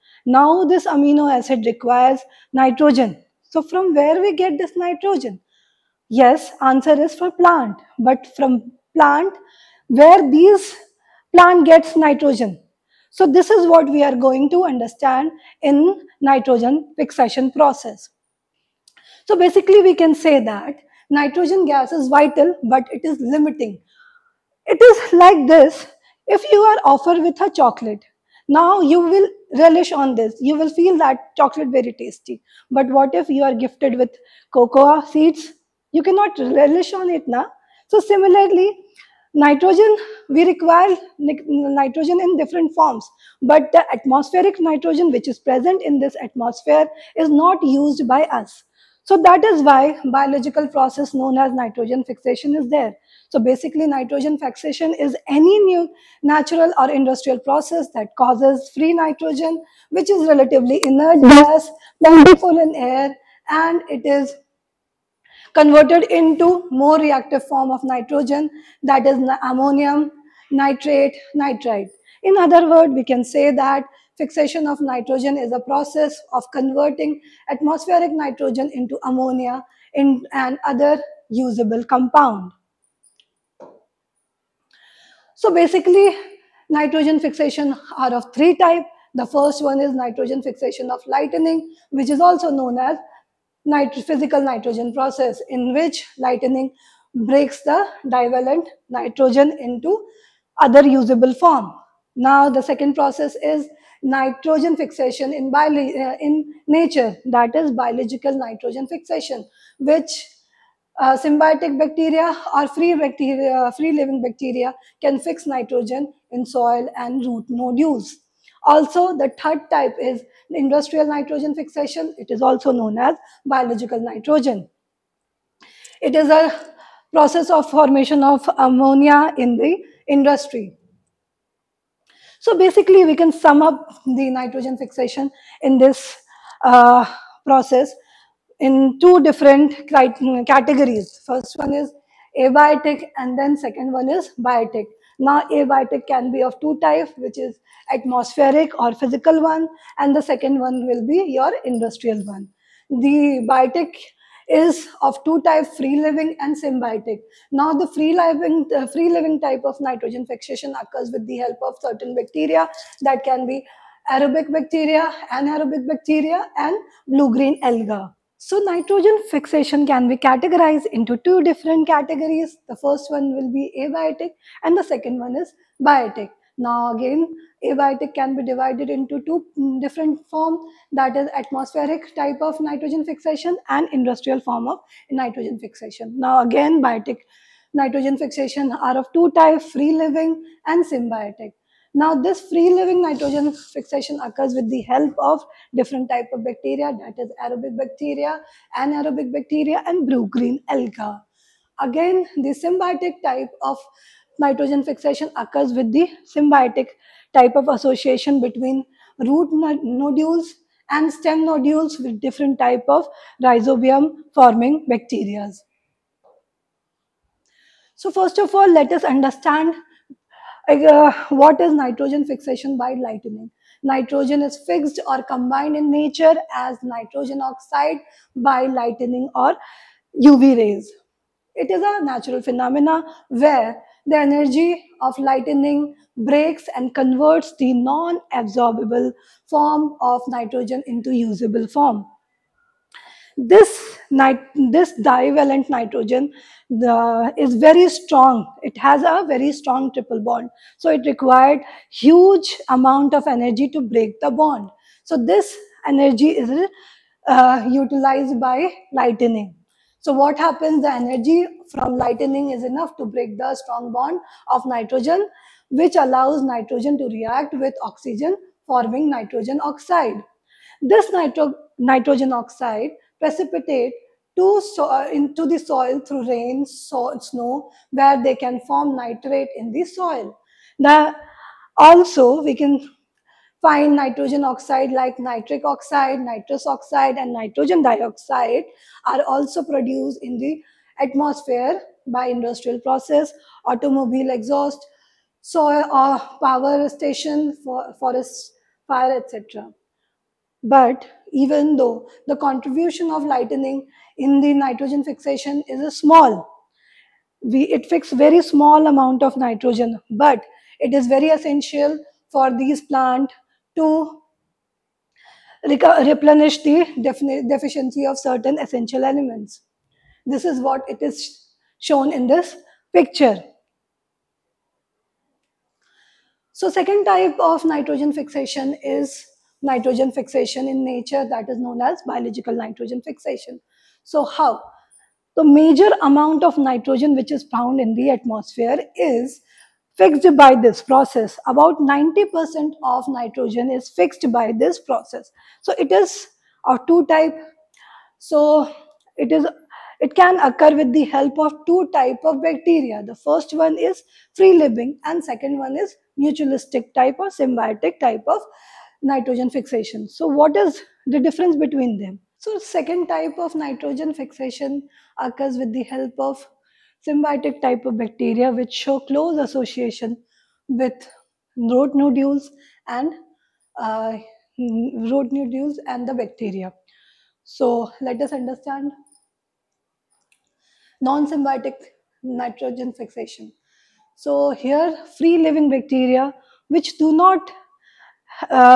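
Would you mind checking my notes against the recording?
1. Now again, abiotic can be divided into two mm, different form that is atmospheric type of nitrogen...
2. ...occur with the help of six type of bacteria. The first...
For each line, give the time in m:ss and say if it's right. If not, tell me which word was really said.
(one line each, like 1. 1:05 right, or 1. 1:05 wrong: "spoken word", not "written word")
1. 2:56 right
2. 5:50 wrong: "two", not "six".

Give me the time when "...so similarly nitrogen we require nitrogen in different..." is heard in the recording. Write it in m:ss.
0:37.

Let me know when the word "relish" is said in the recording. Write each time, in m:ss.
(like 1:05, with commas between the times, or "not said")
0:29, 0:36.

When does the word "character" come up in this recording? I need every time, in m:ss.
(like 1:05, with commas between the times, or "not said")
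not said.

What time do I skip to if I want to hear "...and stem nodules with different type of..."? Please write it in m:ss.
3:30.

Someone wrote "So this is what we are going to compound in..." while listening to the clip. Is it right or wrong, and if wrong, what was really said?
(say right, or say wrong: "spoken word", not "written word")
wrong: "understand", not "compound".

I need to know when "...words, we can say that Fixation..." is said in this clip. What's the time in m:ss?
1:12.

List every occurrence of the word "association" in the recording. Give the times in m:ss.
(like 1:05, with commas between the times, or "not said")
3:27, 6:09.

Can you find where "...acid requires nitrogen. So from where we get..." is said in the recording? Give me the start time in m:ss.
0:01.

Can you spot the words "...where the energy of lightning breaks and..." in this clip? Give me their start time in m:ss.
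3:53.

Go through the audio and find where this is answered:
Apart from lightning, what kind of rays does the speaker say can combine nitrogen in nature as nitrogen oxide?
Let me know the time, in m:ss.
3:50.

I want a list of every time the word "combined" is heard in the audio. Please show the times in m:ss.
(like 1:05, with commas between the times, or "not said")
3:45.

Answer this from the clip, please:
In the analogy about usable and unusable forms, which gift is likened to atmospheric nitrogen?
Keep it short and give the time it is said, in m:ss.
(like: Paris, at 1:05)
Cocoa seeds, at 0:34.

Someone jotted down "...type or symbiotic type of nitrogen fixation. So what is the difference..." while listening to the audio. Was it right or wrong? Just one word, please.
right.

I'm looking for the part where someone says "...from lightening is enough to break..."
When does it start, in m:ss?
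4:21.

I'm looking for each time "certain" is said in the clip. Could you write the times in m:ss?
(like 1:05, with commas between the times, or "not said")
2:41, 5:18.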